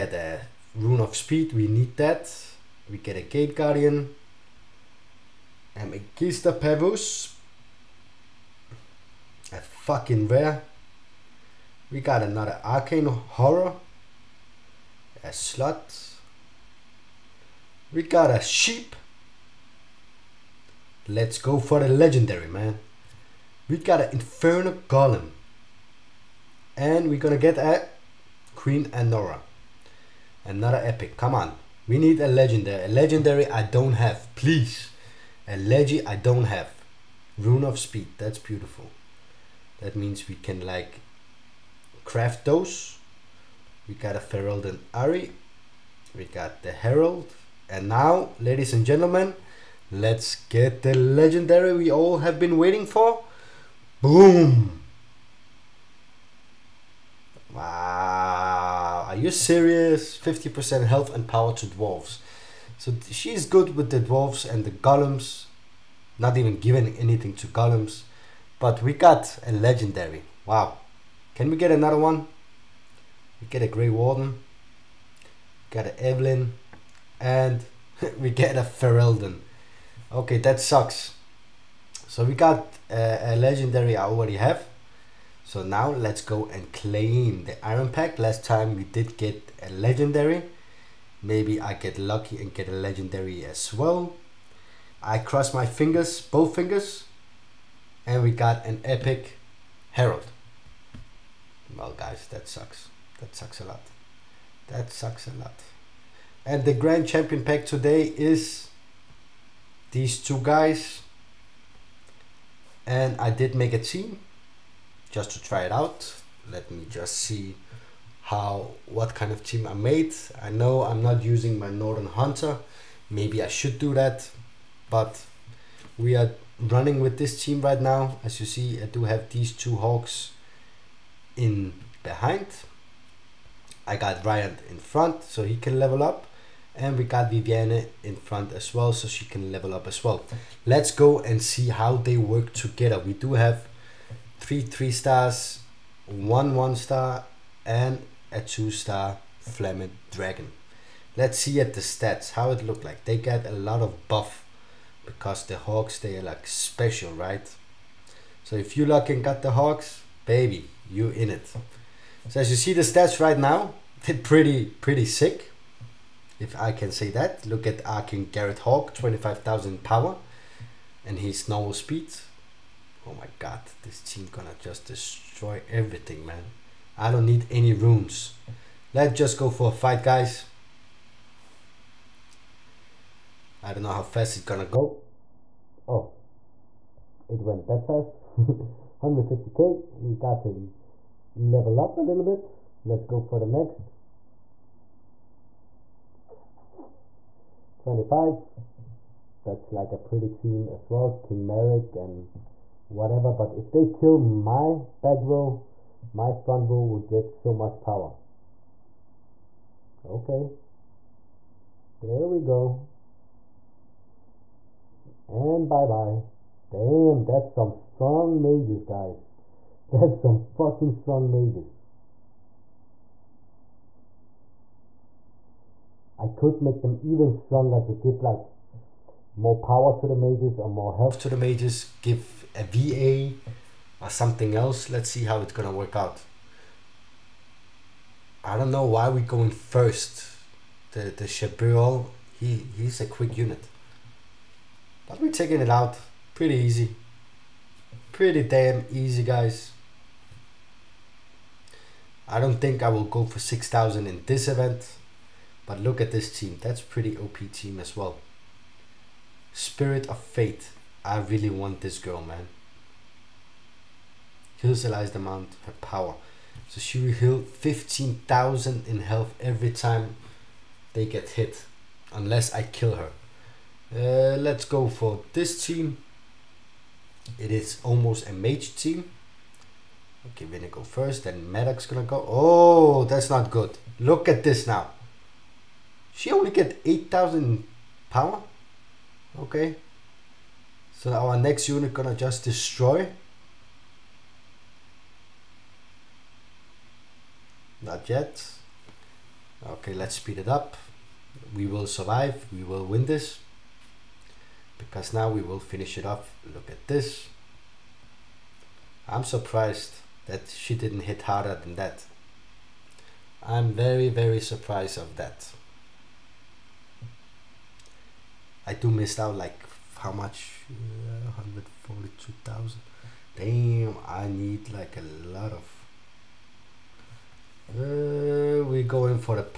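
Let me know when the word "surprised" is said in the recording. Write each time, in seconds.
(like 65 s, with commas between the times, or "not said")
309 s, 314 s.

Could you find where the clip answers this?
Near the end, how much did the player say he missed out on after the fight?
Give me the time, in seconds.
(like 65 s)
321 s.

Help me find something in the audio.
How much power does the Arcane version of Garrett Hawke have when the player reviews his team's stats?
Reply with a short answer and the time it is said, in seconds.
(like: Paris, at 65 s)
25,000, at 168 s.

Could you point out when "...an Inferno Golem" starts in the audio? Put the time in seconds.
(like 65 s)
24 s.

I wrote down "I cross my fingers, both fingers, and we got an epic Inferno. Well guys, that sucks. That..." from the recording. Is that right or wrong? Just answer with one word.
wrong.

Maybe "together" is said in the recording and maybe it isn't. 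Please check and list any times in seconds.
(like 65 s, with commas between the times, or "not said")
142 s.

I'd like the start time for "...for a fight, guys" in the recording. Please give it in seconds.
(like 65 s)
179 s.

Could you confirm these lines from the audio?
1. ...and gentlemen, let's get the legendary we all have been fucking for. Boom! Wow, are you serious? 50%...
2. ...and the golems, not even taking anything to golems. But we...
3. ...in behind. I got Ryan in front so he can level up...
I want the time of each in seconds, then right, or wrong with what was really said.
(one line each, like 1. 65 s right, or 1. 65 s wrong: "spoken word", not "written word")
1. 48 s wrong: "waiting", not "fucking"
2. 64 s wrong: "giving", not "taking"
3. 131 s right.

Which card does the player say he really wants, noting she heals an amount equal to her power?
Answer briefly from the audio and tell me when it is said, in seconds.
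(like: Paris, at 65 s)
Spirit of Fate, at 259 s.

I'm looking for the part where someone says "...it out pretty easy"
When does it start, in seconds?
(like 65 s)
245 s.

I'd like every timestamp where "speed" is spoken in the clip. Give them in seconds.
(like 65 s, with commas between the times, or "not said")
1 s, 37 s, 171 s, 300 s.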